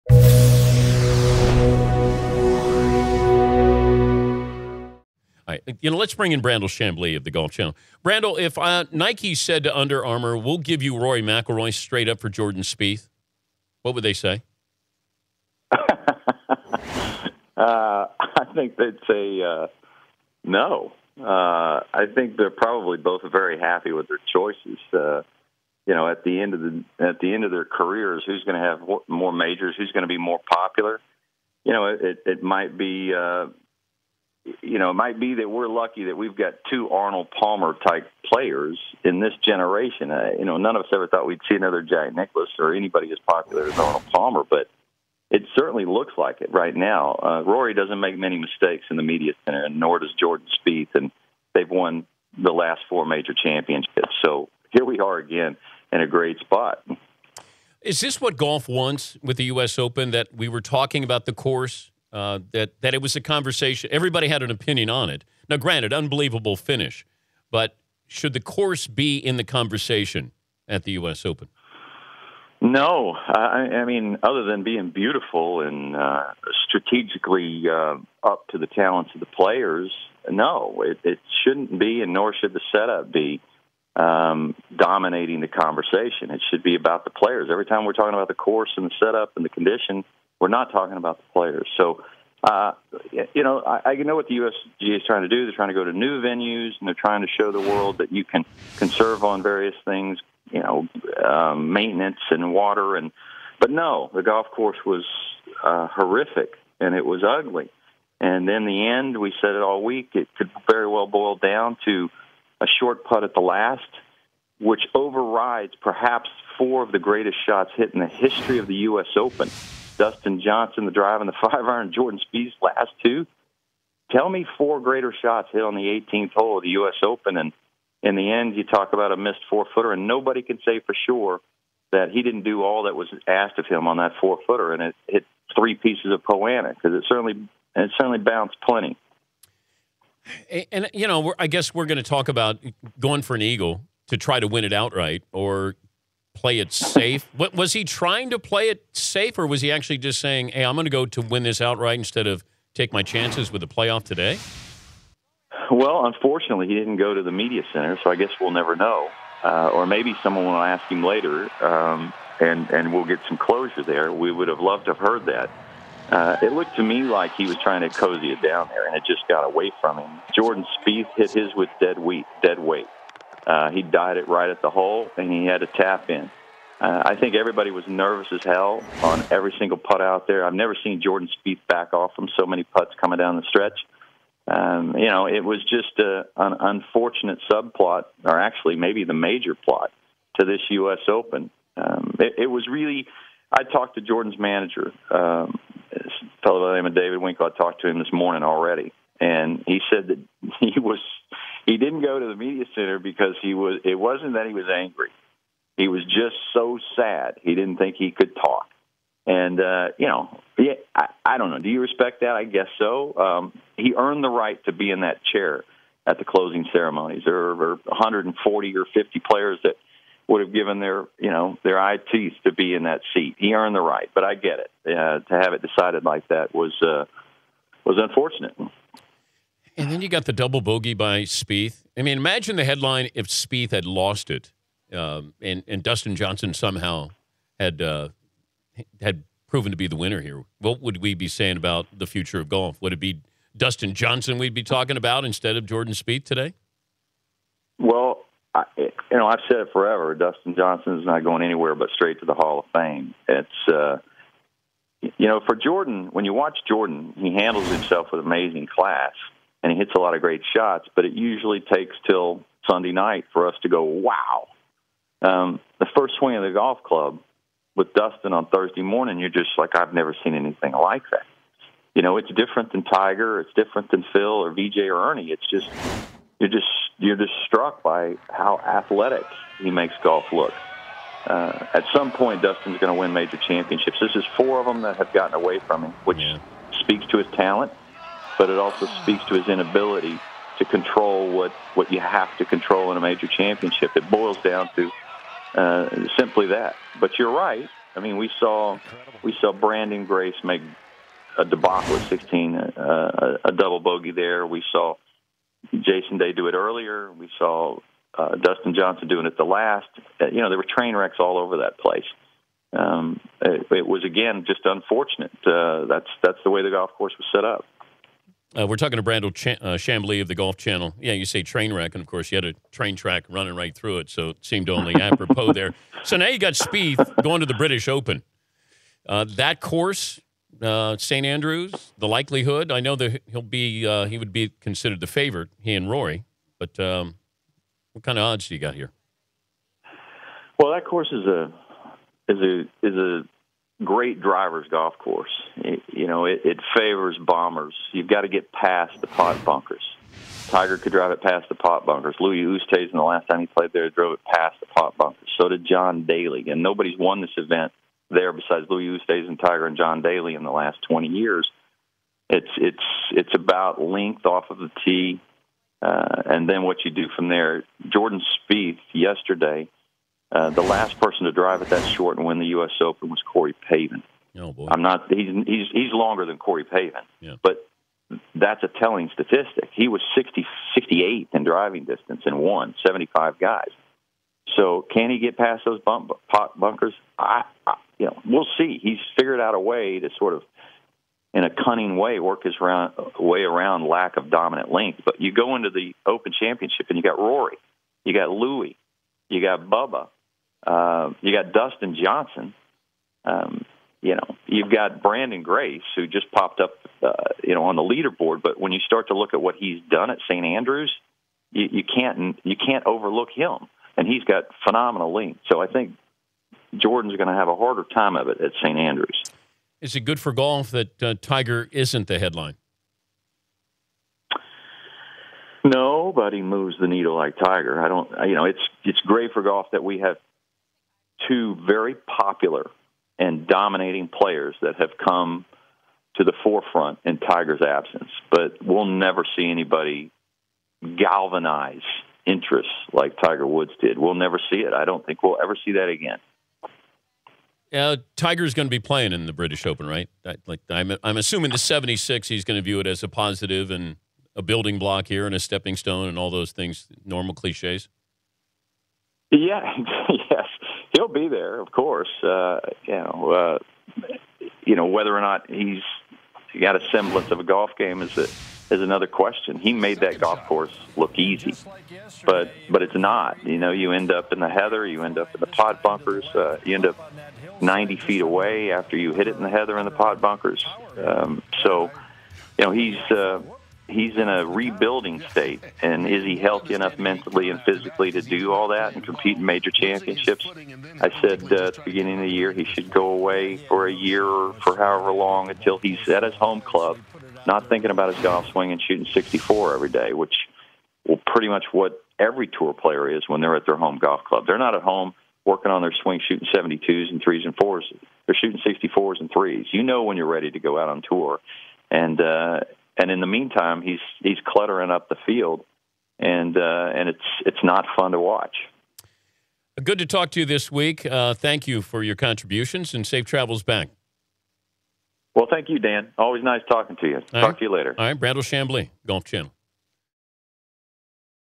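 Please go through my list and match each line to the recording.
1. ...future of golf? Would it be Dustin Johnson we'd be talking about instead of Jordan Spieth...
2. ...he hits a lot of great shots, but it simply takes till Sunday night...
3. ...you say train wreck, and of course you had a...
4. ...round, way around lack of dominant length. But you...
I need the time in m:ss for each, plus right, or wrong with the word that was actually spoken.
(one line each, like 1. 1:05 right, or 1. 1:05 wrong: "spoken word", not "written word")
1. 4:02 right
2. 4:19 wrong: "usually", not "simply"
3. 5:21 right
4. 6:32 right.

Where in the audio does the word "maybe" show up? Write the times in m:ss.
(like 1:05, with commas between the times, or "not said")
2:39, 3:08.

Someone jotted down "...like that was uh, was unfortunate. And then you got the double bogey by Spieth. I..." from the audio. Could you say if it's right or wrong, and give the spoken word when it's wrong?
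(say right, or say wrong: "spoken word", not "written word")
right.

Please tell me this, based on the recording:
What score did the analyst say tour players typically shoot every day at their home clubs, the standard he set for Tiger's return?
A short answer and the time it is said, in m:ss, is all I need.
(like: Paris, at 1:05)
64, at 8:19.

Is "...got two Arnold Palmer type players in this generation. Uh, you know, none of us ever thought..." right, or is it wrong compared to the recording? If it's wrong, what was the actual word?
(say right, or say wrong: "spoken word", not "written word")
right.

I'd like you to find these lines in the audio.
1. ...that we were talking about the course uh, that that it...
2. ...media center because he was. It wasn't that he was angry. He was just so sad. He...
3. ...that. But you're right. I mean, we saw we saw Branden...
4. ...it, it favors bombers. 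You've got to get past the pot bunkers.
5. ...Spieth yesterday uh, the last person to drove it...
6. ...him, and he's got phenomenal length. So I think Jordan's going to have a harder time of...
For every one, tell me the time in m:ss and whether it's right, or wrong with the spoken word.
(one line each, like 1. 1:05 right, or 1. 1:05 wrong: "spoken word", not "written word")
1. 1:00 right
2. 3:22 right
3. 4:56 right
4. 5:46 right
5. 6:08 wrong: "drive", not "drove"
6. 6:53 right.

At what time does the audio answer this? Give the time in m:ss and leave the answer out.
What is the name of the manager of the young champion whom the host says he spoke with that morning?
3:16.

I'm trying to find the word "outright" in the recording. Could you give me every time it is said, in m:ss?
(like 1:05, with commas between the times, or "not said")
2:24, 2:31.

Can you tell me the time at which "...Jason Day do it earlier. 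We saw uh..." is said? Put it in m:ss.
5:05.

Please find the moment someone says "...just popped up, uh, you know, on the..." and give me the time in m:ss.
6:46.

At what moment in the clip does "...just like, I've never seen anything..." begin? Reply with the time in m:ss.
4:29.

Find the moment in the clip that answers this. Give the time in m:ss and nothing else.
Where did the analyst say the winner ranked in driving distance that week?
6:20.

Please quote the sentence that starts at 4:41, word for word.
Uh, at some point, Dustin's going to win major championships.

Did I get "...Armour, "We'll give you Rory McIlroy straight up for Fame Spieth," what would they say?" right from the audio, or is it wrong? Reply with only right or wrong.
wrong.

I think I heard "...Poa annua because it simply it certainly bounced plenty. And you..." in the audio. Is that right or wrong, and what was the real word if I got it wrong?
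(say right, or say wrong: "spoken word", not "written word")
wrong: "certainly", not "simply".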